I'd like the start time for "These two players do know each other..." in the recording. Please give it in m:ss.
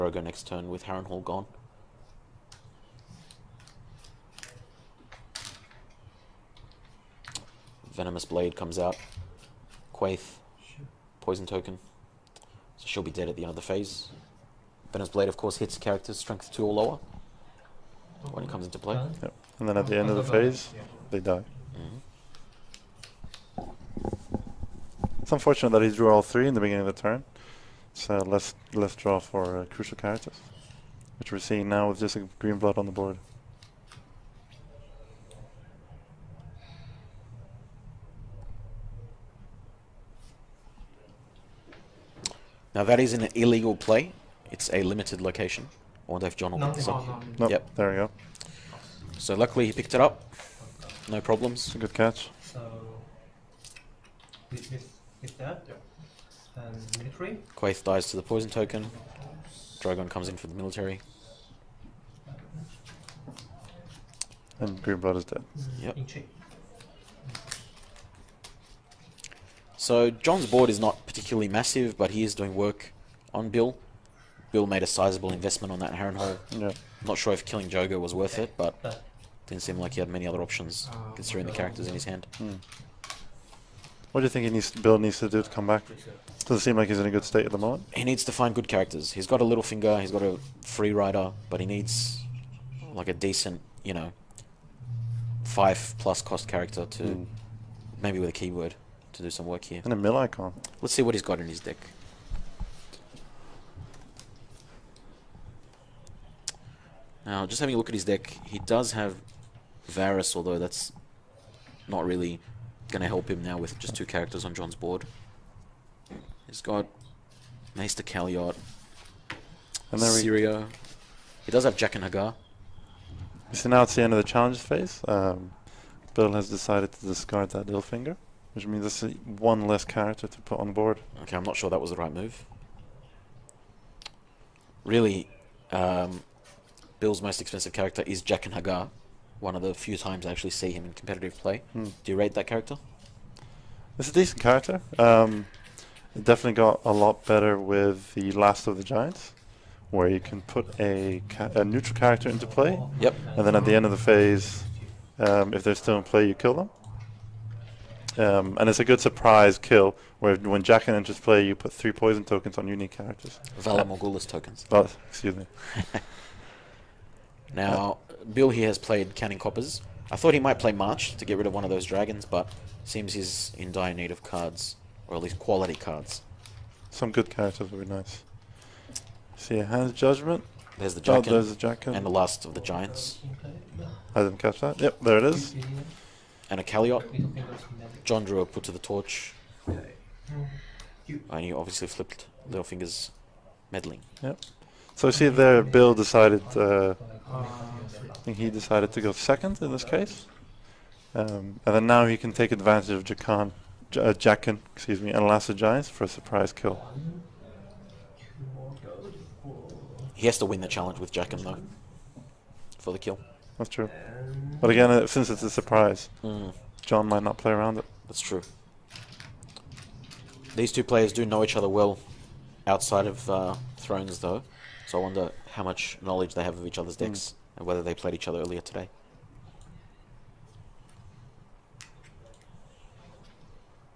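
3:40.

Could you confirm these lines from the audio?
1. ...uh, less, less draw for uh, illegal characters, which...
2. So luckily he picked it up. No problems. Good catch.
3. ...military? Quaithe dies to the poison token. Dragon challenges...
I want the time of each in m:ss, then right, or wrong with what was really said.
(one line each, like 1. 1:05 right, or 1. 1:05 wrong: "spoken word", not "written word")
1. 0:28 wrong: "crucial", not "illegal"
2. 0:49 right
3. 0:56 wrong: "comes", not "challenges".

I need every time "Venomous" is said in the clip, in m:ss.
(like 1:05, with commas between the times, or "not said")
0:07, 0:14.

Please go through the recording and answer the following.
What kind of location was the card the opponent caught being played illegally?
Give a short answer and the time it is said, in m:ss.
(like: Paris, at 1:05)
Limited location, at 0:44.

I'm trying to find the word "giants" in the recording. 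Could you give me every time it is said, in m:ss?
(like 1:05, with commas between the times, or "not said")
2:28, 3:02, 3:25.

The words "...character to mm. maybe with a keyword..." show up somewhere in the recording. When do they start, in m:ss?
1:36.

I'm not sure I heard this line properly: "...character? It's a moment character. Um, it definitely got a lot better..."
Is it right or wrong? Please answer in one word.
wrong.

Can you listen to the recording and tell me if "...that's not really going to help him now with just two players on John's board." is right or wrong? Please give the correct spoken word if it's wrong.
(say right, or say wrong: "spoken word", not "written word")
wrong: "characters", not "players".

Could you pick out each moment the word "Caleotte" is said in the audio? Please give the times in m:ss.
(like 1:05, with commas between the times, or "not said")
1:58, 3:06.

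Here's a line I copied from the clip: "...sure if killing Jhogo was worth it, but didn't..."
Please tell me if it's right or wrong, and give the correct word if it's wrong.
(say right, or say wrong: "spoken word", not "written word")
right.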